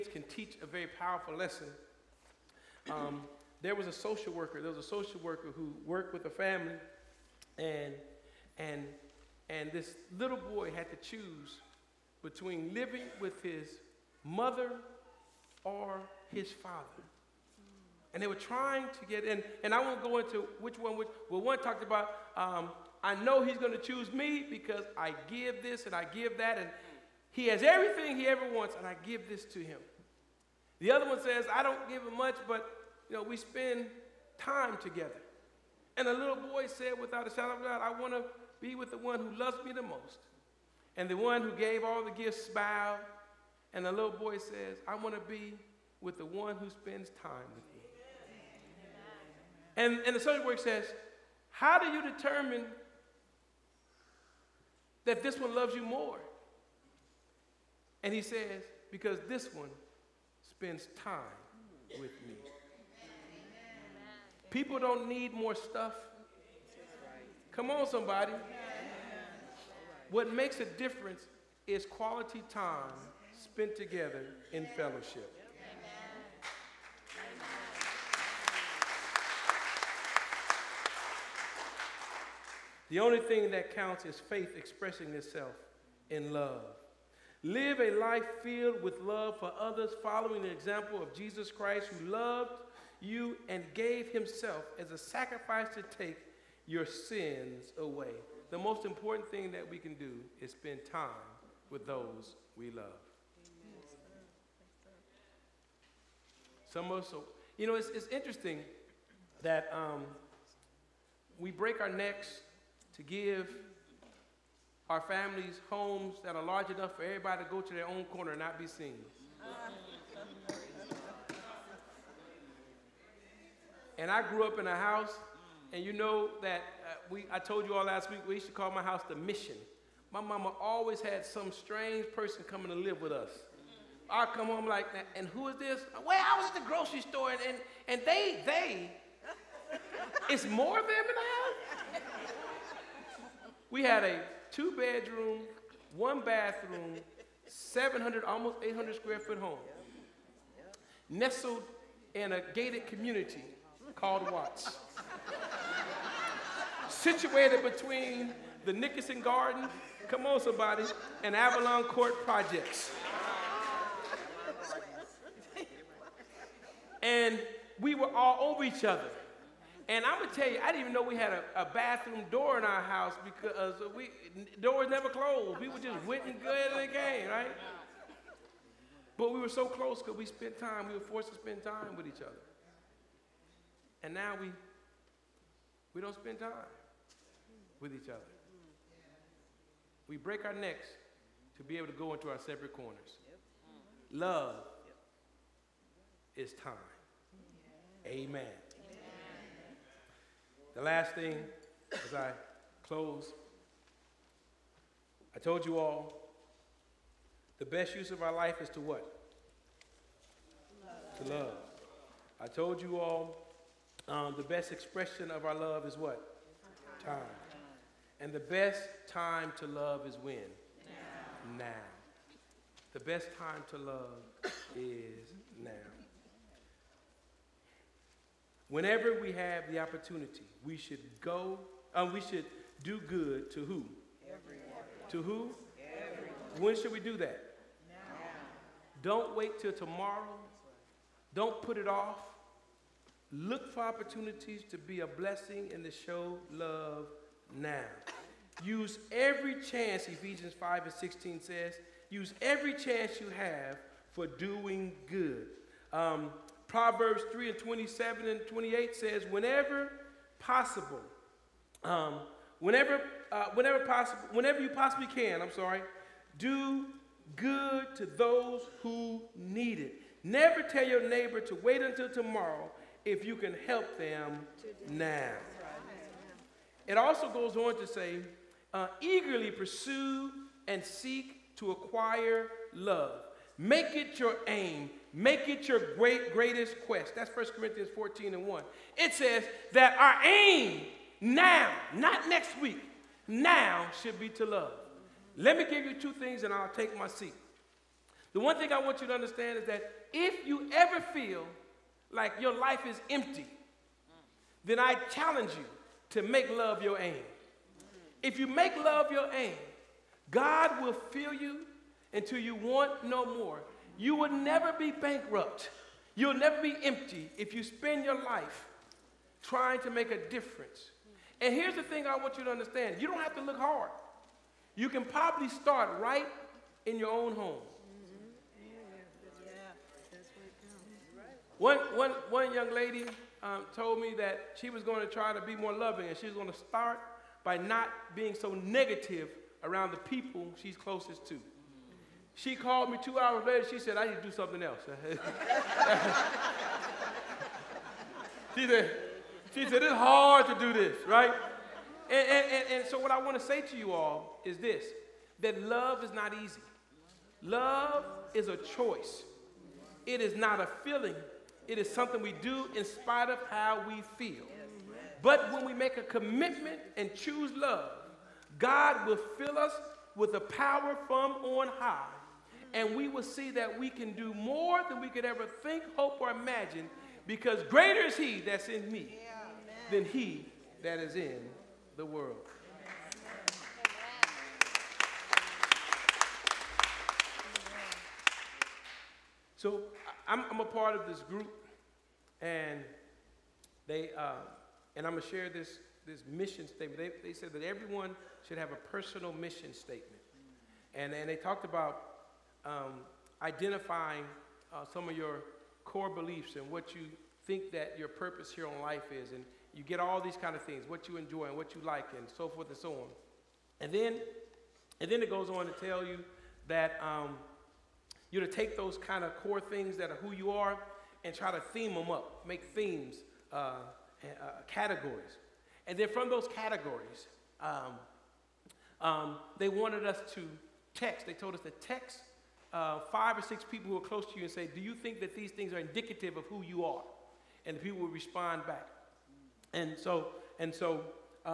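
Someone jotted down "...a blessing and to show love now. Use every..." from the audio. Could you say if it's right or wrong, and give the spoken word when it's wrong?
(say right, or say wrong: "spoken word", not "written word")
right.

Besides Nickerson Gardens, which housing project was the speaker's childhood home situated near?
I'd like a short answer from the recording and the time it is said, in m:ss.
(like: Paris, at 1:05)
Avalon Court, at 2:41.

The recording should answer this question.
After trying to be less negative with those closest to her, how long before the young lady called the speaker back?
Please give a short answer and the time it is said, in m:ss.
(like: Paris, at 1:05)
2 hours, at 5:43.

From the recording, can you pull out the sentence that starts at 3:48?
Whenever we have the opportunity, we should go, uh, we should do good to who?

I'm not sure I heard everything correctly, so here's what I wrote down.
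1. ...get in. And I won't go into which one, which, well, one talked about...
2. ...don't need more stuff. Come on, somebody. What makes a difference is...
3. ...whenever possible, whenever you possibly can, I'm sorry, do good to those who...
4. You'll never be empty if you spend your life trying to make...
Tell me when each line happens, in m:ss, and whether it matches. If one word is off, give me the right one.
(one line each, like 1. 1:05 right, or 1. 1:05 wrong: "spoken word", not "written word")
1. 0:19 right
2. 1:04 right
3. 4:23 right
4. 5:16 right.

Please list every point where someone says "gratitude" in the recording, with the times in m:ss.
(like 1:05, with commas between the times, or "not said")
not said.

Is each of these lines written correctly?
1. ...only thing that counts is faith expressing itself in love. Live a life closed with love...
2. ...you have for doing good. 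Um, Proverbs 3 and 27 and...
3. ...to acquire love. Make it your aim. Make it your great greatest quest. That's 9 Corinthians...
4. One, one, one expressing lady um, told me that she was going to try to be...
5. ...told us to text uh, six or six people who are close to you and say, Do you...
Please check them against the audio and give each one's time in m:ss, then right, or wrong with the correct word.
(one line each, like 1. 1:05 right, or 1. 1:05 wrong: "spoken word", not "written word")
1. 1:23 wrong: "filled", not "closed"
2. 4:13 right
3. 4:41 wrong: "1", not "9"
4. 5:31 wrong: "young", not "expressing"
5. 7:11 wrong: "five", not "six".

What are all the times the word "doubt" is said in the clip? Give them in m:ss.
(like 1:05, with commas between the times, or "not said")
0:37.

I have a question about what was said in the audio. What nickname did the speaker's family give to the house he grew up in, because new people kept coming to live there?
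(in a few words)
The mission.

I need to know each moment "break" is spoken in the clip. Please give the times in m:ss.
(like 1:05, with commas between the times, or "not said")
1:51, 3:10.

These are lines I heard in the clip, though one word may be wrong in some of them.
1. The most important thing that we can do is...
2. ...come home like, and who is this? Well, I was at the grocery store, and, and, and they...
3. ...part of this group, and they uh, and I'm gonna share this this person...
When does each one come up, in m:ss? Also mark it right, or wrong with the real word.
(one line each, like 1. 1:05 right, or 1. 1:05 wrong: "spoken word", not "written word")
1. 1:38 right
2. 2:14 right
3. 6:30 wrong: "mission", not "person".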